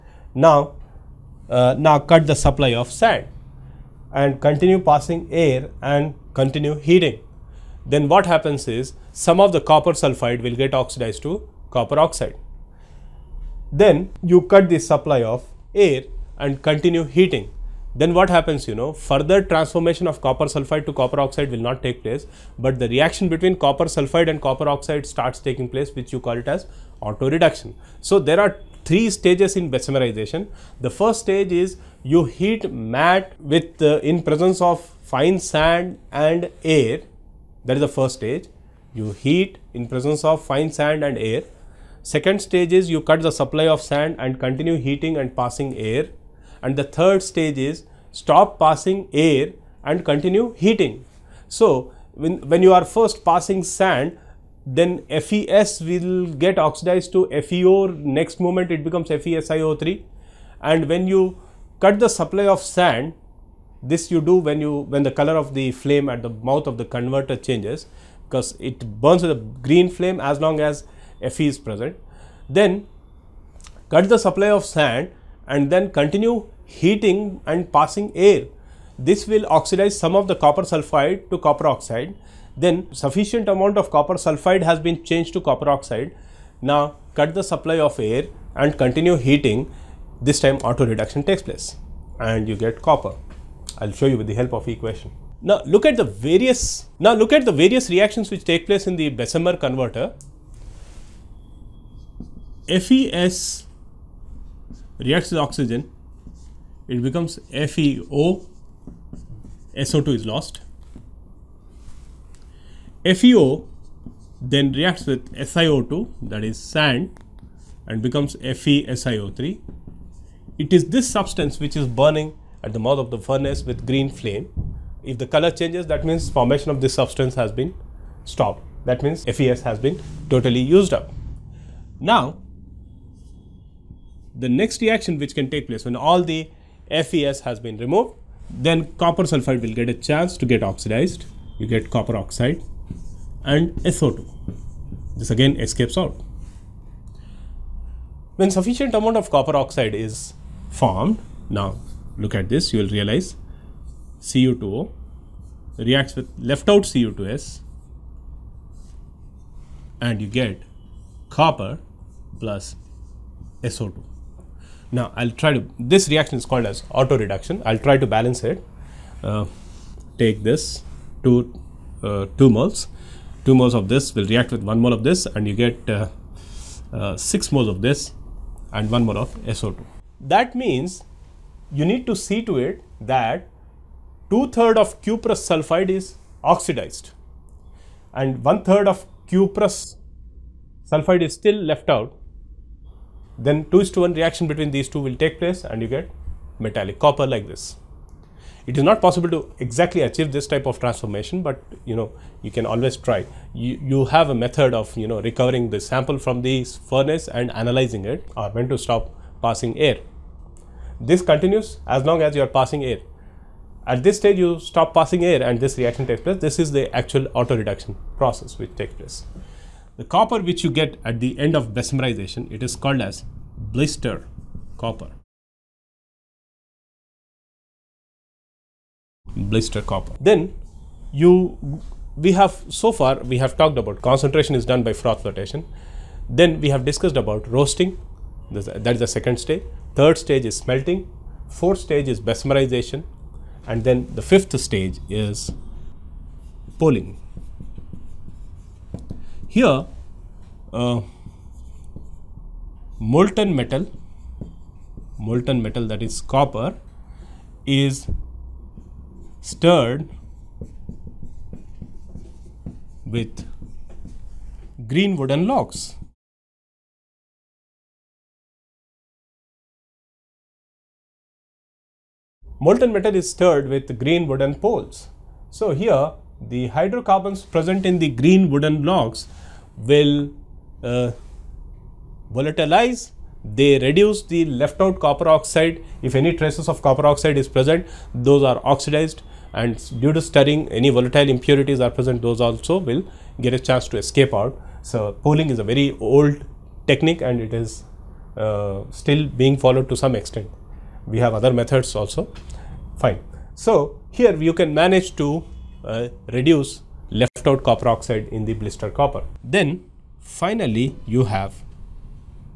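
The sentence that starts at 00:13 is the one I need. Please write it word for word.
Then you cut the supply of air and continue heating.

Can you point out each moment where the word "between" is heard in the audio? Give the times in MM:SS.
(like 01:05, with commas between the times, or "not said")
00:23, 03:14.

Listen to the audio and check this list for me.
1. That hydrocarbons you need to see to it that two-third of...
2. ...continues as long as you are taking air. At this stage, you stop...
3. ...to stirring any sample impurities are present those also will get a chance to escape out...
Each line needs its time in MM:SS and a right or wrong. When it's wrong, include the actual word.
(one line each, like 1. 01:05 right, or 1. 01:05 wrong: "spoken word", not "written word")
1. 03:00 wrong: "means", not "hydrocarbons"
2. 03:31 wrong: "passing", not "taking"
3. 04:50 wrong: "volatile", not "sample".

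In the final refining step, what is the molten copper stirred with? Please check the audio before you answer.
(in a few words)
Green wooden logs.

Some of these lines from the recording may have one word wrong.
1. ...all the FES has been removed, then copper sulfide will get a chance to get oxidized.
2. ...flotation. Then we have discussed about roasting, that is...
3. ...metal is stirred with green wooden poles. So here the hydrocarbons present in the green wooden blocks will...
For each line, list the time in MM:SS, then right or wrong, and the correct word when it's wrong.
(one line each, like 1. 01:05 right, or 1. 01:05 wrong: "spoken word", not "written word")
1. 02:15 right
2. 03:55 right
3. 04:32 right.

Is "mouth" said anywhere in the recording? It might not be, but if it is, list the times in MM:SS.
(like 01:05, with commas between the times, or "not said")
01:06, 02:02.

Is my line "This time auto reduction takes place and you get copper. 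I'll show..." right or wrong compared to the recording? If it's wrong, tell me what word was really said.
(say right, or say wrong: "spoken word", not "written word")
right.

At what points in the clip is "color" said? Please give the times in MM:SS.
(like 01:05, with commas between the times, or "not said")
01:05, 02:05.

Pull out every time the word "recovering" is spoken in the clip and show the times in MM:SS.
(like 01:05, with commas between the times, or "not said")
03:25.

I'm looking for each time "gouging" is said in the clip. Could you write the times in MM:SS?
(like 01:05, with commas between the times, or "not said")
not said.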